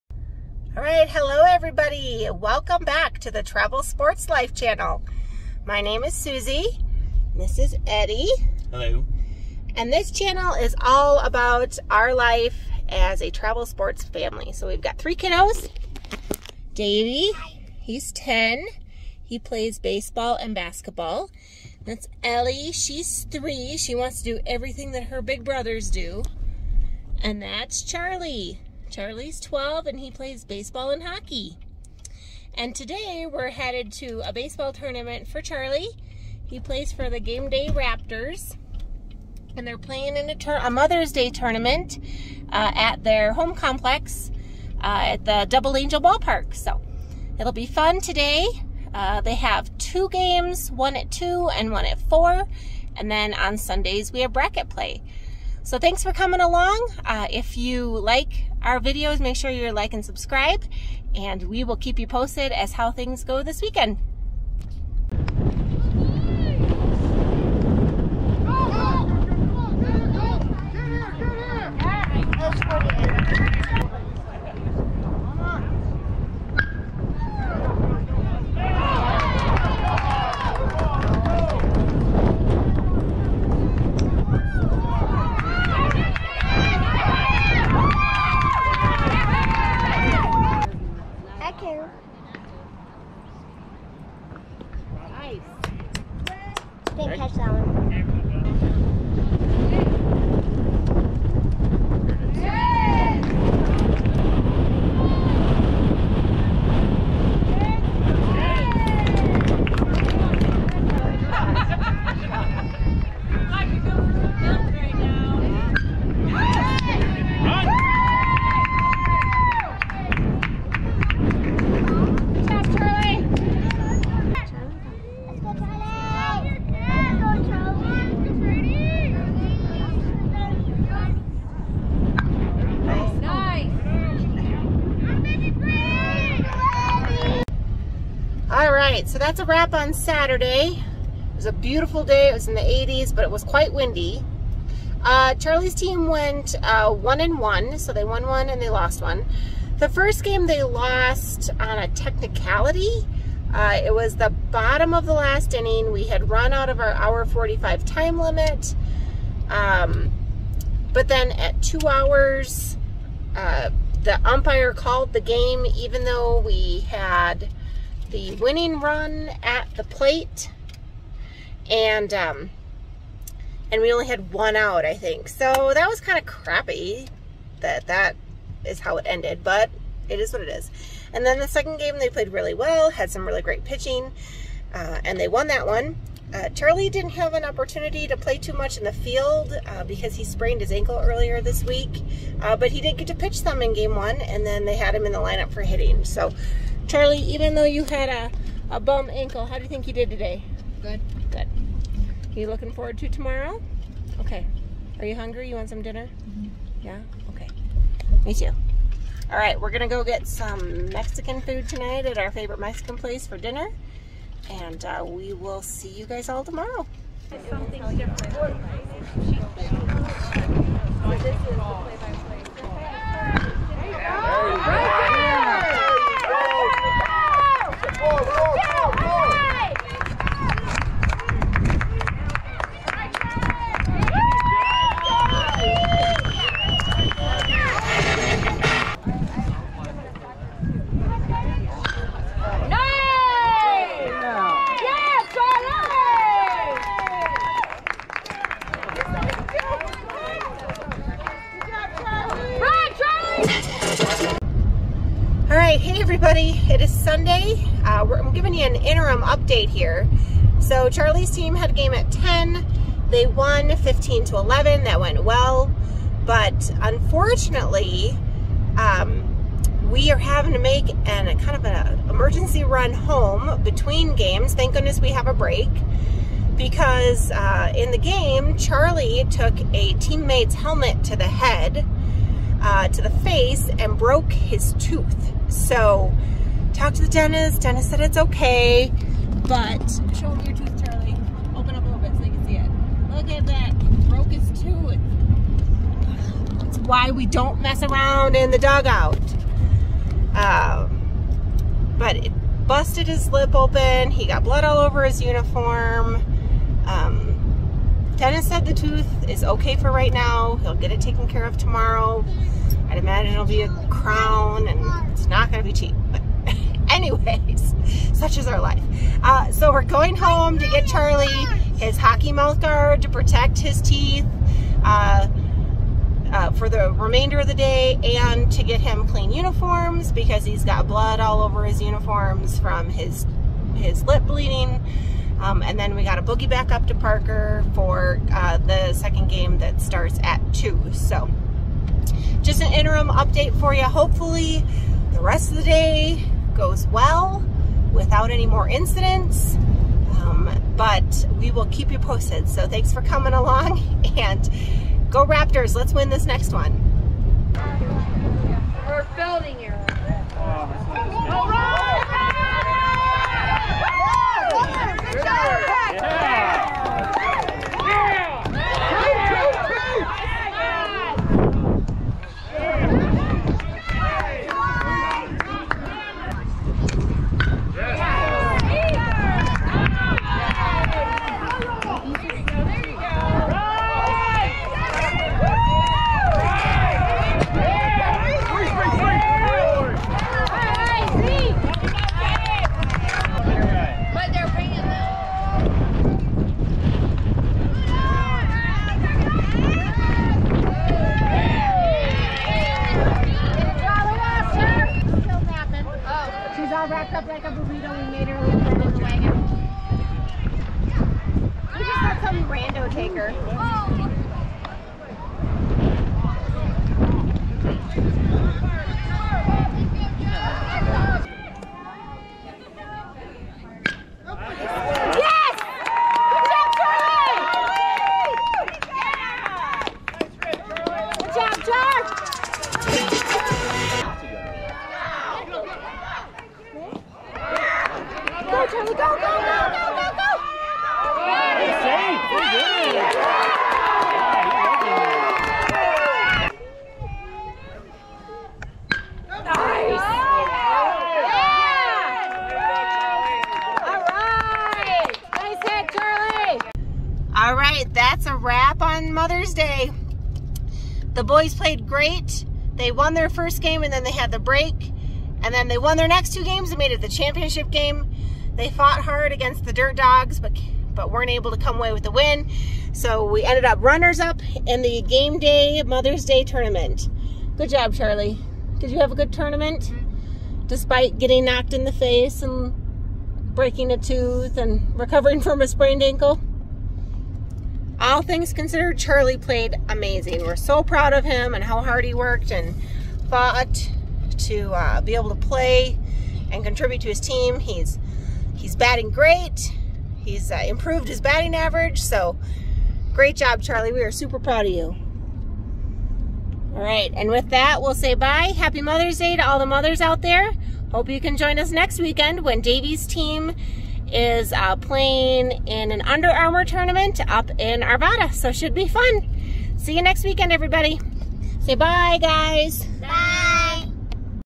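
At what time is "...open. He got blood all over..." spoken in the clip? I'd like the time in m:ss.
5:03.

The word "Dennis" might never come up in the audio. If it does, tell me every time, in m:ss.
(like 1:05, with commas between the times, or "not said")
4:47, 5:08.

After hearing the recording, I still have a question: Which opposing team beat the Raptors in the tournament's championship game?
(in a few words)
Dirt Dogs.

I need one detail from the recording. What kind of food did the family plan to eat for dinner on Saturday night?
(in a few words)
Mexican food.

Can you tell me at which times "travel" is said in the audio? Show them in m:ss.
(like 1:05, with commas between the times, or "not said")
0:03, 0:13.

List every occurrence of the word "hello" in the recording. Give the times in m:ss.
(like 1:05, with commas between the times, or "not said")
0:01, 0:08.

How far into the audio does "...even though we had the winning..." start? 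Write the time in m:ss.
2:45.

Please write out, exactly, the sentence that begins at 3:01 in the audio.
And then the second game, they played really well, had some really great pitching, uh, and they won that one.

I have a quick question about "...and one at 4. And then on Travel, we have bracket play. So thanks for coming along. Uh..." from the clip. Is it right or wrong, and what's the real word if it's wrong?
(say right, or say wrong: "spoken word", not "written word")
wrong: "Sundays", not "Travel".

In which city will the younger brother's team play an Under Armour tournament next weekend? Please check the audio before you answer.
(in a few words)
Arvada.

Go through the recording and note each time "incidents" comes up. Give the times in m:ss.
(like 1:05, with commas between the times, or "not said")
5:48.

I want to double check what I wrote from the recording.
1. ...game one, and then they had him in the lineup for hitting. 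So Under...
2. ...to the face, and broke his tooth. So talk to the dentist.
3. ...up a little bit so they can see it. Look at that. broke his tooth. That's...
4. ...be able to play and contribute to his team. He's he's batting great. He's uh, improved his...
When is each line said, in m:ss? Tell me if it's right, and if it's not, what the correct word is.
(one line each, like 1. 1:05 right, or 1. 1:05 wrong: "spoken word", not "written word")
1. 3:13 wrong: "Charlie", not "Under"
2. 4:42 right
3. 4:51 right
4. 8:15 right.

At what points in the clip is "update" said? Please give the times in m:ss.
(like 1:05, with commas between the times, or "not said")
4:19, 5:43.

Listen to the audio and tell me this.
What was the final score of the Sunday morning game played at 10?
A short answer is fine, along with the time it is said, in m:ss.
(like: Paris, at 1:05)
15 to 11, at 4:23.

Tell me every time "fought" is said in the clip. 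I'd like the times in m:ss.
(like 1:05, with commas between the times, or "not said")
7:48, 8:13.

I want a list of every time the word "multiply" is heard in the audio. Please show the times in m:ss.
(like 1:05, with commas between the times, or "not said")
not said.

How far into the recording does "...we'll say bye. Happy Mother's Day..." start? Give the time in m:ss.
8:27.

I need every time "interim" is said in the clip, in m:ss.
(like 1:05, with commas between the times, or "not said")
4:18, 5:42.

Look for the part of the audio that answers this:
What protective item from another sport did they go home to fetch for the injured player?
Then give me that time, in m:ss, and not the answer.
5:21.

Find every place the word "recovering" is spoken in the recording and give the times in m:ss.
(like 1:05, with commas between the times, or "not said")
8:04.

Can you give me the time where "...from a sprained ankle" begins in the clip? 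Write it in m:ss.
8:05.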